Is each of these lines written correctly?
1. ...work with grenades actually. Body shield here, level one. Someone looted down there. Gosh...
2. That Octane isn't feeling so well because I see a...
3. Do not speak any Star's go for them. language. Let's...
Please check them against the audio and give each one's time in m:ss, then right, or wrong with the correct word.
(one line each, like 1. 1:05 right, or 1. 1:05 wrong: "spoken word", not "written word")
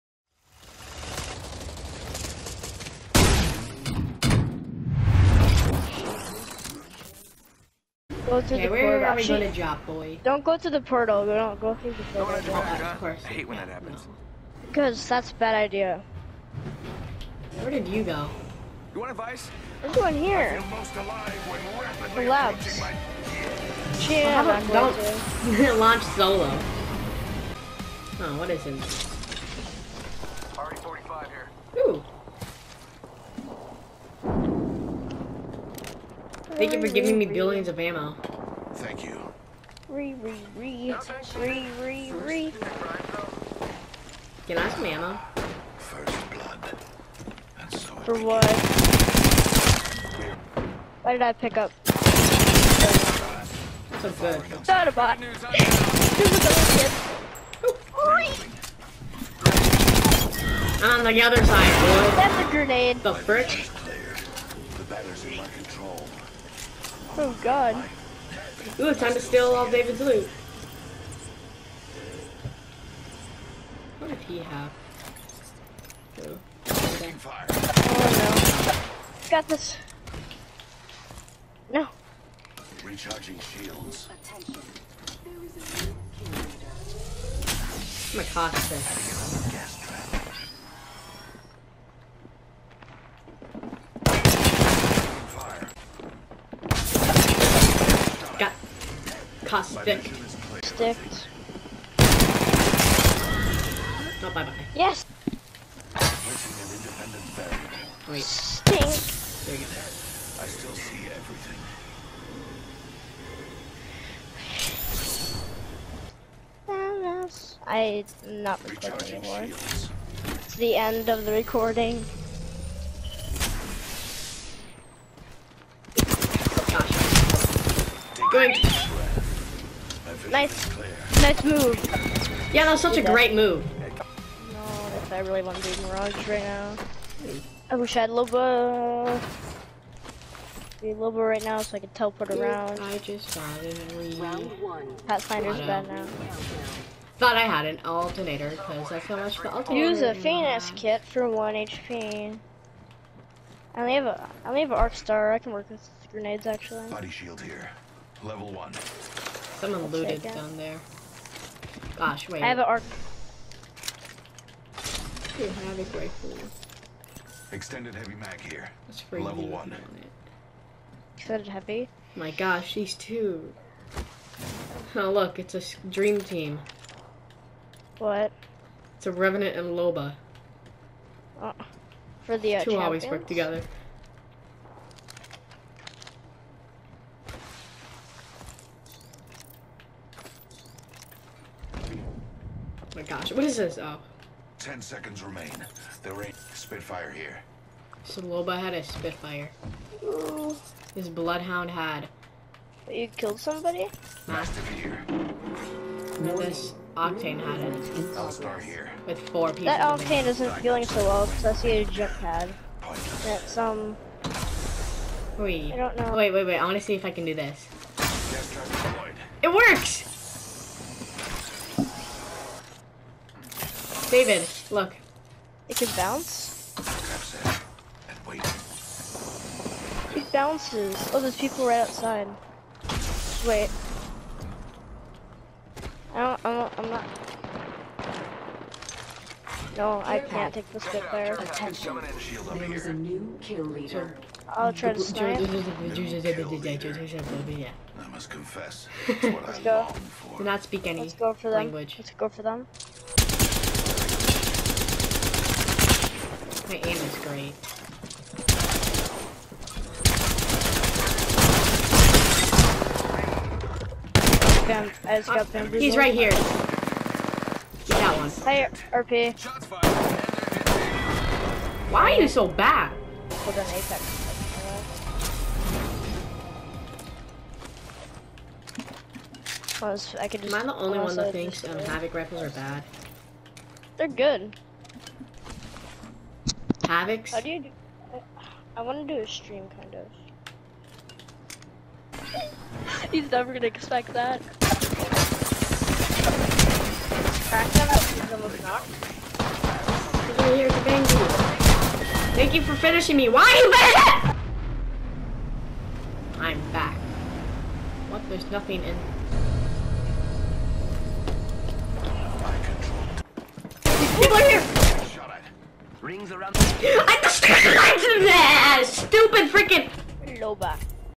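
1. 2:35 right
2. 3:29 right
3. 4:10 wrong: "Let", not "Star".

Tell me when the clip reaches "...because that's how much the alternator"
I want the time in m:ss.
2:28.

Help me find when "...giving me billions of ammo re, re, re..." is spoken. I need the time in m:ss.
0:36.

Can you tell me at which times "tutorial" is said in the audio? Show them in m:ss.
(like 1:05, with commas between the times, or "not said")
not said.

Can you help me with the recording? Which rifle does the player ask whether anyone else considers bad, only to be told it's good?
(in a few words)
Havoc.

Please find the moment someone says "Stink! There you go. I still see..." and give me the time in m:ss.
1:48.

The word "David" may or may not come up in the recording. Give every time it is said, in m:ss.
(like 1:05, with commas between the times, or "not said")
1:09, 3:44.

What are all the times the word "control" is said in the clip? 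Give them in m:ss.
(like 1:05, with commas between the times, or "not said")
1:05.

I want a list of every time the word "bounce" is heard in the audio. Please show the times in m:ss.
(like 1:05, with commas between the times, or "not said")
3:45, 3:50.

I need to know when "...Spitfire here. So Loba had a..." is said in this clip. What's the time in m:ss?
3:16.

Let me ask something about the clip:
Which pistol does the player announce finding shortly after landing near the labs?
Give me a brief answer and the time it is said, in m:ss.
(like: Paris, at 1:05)
RE-45, at 0:30.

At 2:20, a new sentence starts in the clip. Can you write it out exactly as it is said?
Be Loba right now so I could teleport around.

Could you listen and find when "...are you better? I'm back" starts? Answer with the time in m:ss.
5:03.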